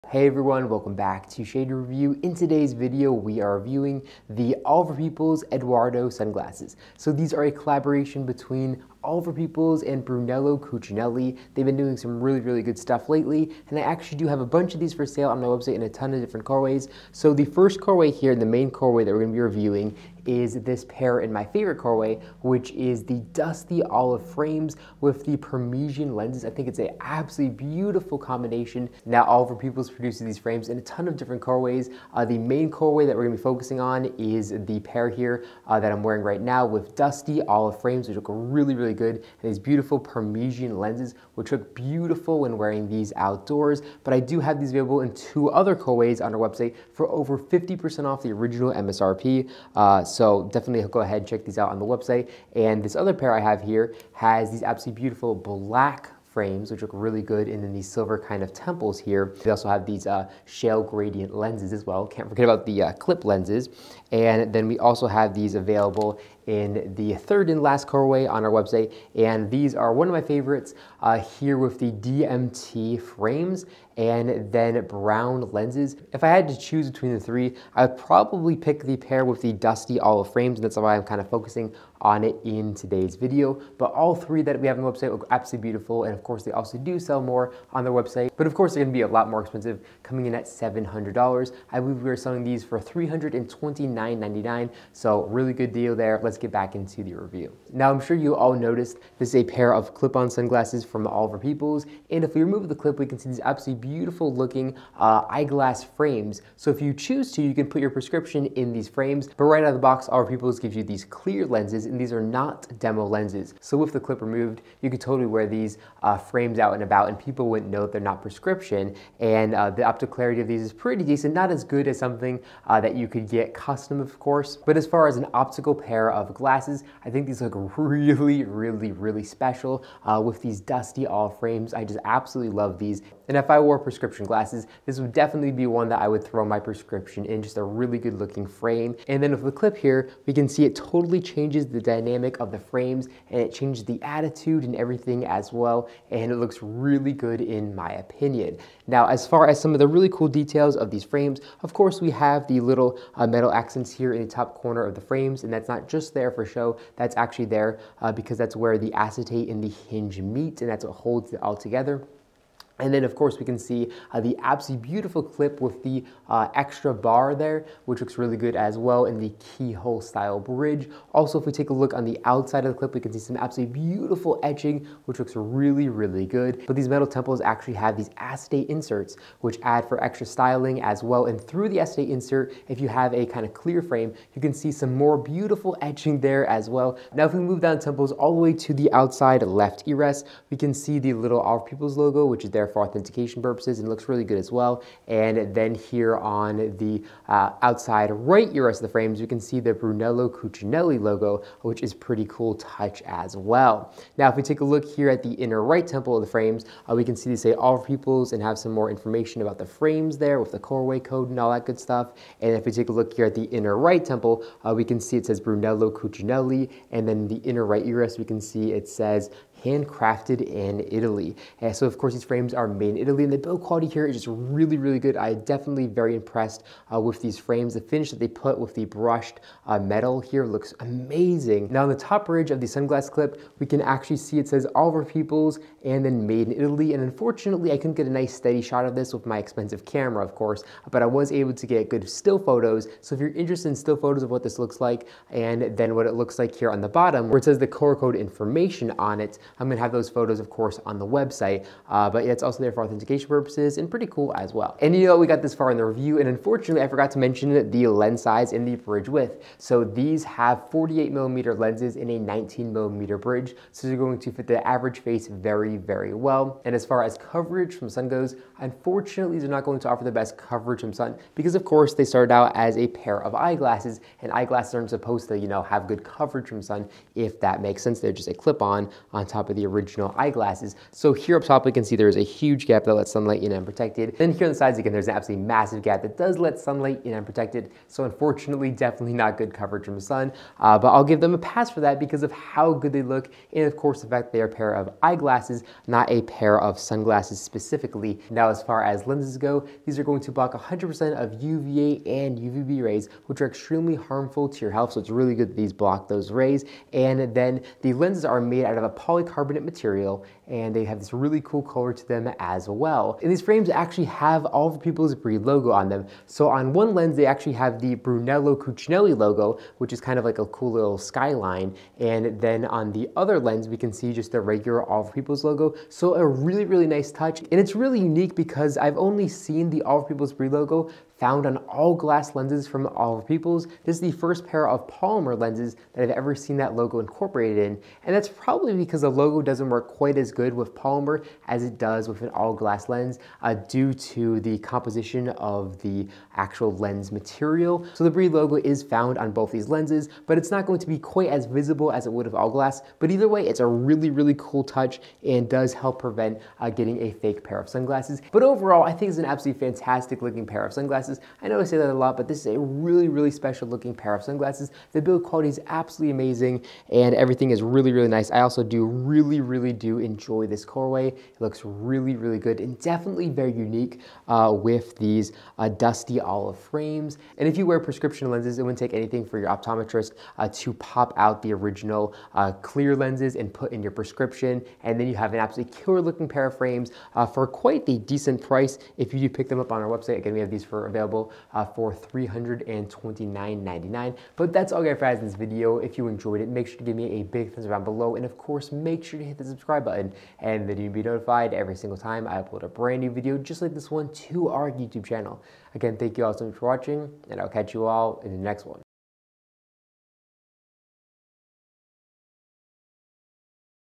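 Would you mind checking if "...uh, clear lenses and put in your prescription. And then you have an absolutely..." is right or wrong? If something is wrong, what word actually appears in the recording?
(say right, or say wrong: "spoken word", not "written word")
right.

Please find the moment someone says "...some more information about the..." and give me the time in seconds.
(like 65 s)
208 s.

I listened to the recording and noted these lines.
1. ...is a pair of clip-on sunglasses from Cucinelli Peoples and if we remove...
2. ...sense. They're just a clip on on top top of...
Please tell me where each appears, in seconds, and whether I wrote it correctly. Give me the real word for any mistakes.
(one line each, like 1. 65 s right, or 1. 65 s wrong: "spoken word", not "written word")
1. 99 s wrong: "Oliver", not "Cucinelli"
2. 277 s right.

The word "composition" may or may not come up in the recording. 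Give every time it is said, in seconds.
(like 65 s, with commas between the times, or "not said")
344 s.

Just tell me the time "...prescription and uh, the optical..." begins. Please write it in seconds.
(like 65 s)
118 s.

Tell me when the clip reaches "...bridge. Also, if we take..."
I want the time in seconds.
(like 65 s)
170 s.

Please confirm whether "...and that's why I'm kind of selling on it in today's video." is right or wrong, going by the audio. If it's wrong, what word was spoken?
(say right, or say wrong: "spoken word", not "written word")
wrong: "focusing", not "selling".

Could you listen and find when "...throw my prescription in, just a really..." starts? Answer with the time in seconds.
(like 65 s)
136 s.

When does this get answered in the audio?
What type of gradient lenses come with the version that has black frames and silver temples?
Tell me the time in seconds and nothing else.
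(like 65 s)
60 s.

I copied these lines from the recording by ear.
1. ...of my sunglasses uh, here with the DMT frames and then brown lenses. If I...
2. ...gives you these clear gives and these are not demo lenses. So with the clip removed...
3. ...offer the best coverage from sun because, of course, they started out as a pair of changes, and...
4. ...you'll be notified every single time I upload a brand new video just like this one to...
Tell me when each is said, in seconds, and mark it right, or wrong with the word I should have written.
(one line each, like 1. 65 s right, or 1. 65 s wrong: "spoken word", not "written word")
1. 70 s wrong: "favorites", not "sunglasses"
2. 110 s wrong: "lenses", not "gives"
3. 269 s wrong: "eyeglasses", not "changes"
4. 400 s right.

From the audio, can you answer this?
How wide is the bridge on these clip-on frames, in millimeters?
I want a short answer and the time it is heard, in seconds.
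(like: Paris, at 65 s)
19 millimeters, at 262 s.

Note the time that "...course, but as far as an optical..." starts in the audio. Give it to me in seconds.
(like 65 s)
124 s.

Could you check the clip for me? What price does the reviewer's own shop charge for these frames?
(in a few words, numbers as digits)
$329.99.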